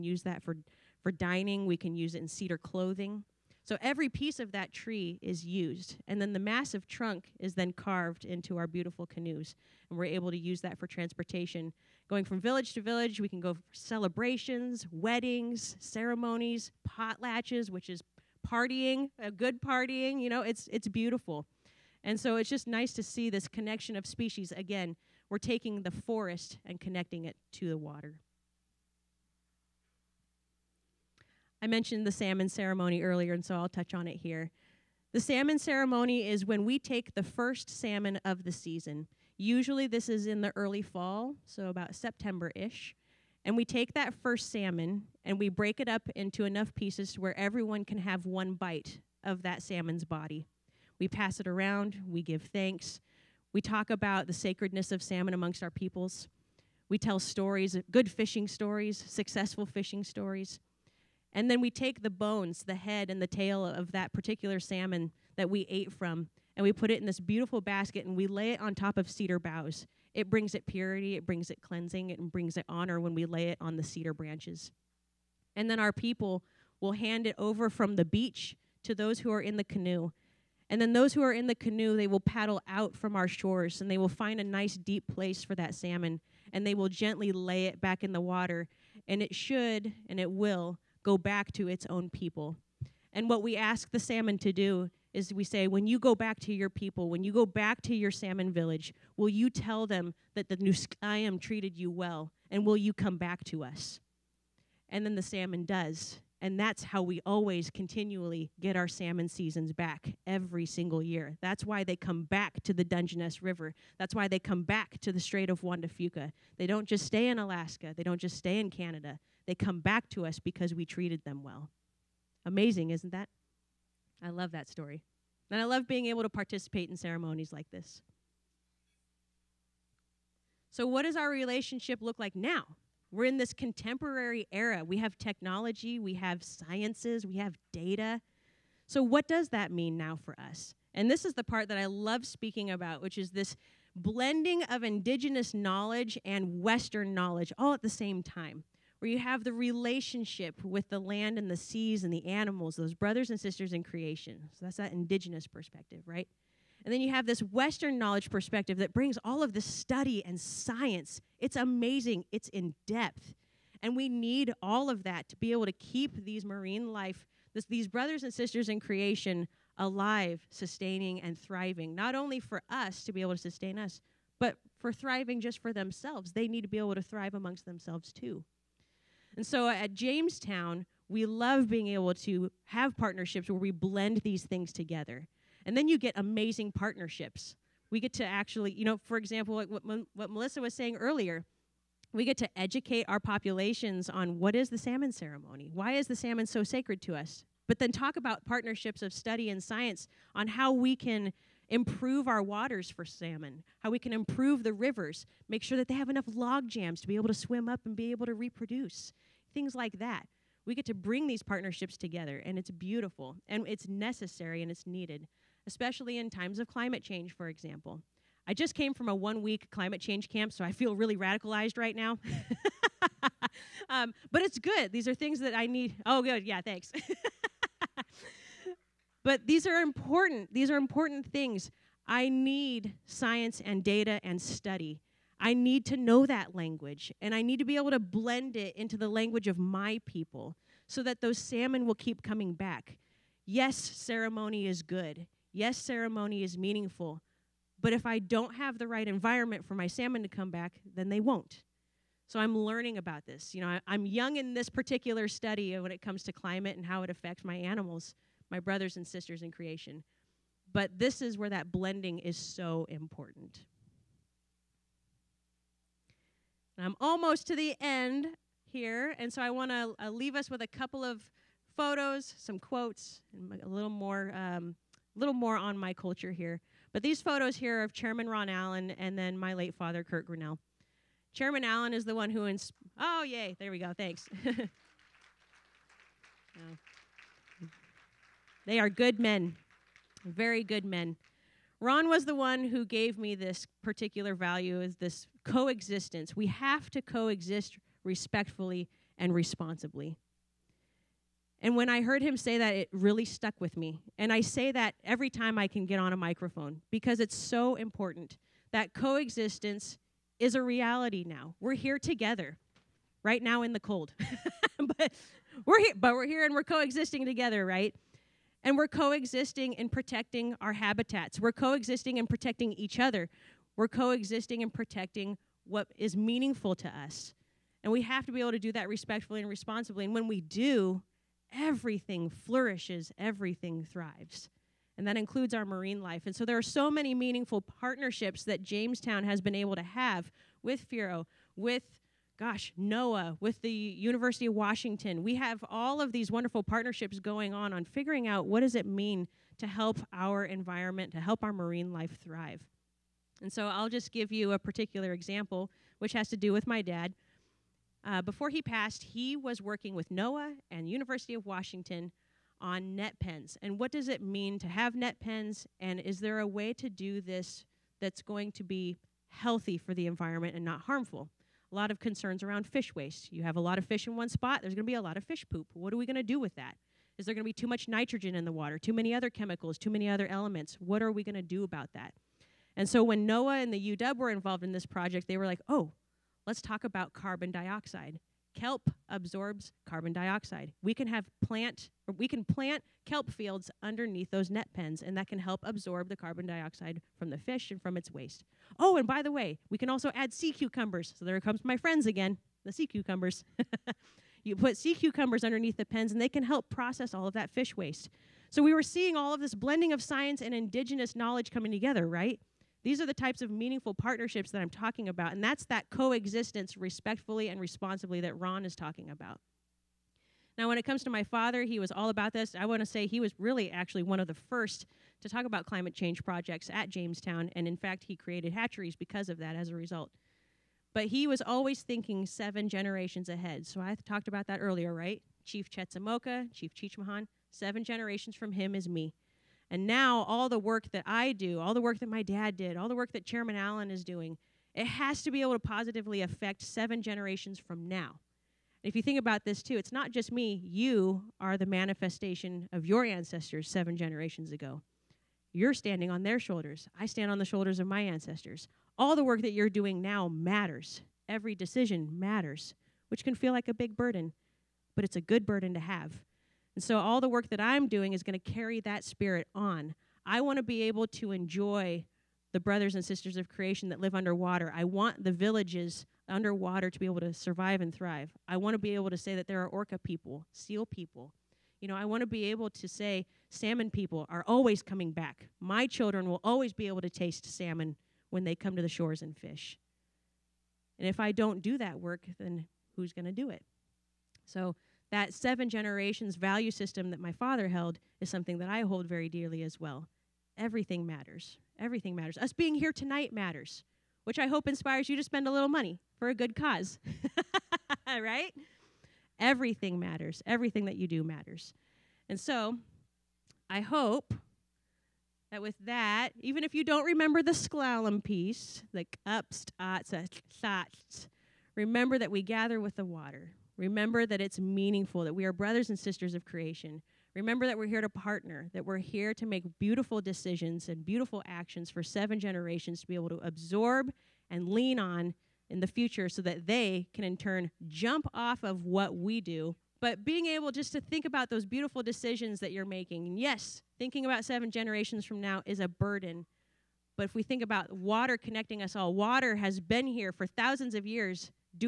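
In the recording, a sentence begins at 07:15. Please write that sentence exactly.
Chief Chetzemoka, Chief Chichmahan, seven generations from him is me.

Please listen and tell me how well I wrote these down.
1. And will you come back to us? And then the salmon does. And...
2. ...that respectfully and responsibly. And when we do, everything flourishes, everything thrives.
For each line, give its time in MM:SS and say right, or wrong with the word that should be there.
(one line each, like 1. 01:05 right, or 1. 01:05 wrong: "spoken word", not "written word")
1. 01:42 right
2. 05:28 right.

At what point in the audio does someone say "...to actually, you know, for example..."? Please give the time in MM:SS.
03:08.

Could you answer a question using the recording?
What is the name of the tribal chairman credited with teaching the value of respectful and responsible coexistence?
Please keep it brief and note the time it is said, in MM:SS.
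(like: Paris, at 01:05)
Ron Allen, at 04:38.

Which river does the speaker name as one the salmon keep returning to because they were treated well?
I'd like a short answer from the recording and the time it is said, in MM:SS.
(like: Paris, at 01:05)
Dungeness River, at 01:52.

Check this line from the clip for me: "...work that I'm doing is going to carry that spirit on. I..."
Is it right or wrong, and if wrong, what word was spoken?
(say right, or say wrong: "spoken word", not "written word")
right.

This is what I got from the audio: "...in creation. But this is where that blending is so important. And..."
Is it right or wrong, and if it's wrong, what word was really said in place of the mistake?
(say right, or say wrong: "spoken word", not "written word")
right.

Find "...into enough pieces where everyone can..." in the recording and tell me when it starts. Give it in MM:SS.
00:46.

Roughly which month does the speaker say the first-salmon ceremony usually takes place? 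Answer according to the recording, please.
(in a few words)
September.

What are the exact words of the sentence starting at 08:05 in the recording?
My children will always be able to taste salmon when they come to the shores and fish.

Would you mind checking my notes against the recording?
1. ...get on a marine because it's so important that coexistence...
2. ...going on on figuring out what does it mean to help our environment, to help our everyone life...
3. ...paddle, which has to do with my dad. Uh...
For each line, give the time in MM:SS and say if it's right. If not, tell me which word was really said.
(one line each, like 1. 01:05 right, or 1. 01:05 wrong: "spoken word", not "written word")
1. 05:05 wrong: "microphone", not "marine"
2. 05:47 wrong: "marine", not "everyone"
3. 05:55 wrong: "example", not "paddle".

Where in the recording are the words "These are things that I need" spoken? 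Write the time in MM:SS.
03:44.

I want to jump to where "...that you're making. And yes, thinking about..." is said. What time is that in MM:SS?
09:02.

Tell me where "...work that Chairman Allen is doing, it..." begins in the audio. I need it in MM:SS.
07:22.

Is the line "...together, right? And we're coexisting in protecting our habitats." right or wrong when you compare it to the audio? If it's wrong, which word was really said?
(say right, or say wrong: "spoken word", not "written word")
right.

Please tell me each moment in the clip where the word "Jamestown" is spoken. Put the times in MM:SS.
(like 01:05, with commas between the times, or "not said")
02:59, 05:38, 07:06.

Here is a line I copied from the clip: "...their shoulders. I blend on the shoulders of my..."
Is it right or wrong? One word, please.
wrong.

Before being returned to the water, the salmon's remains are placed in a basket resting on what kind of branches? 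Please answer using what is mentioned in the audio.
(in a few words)
Cedar boughs.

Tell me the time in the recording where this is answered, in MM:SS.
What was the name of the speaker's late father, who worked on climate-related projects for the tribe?
04:40.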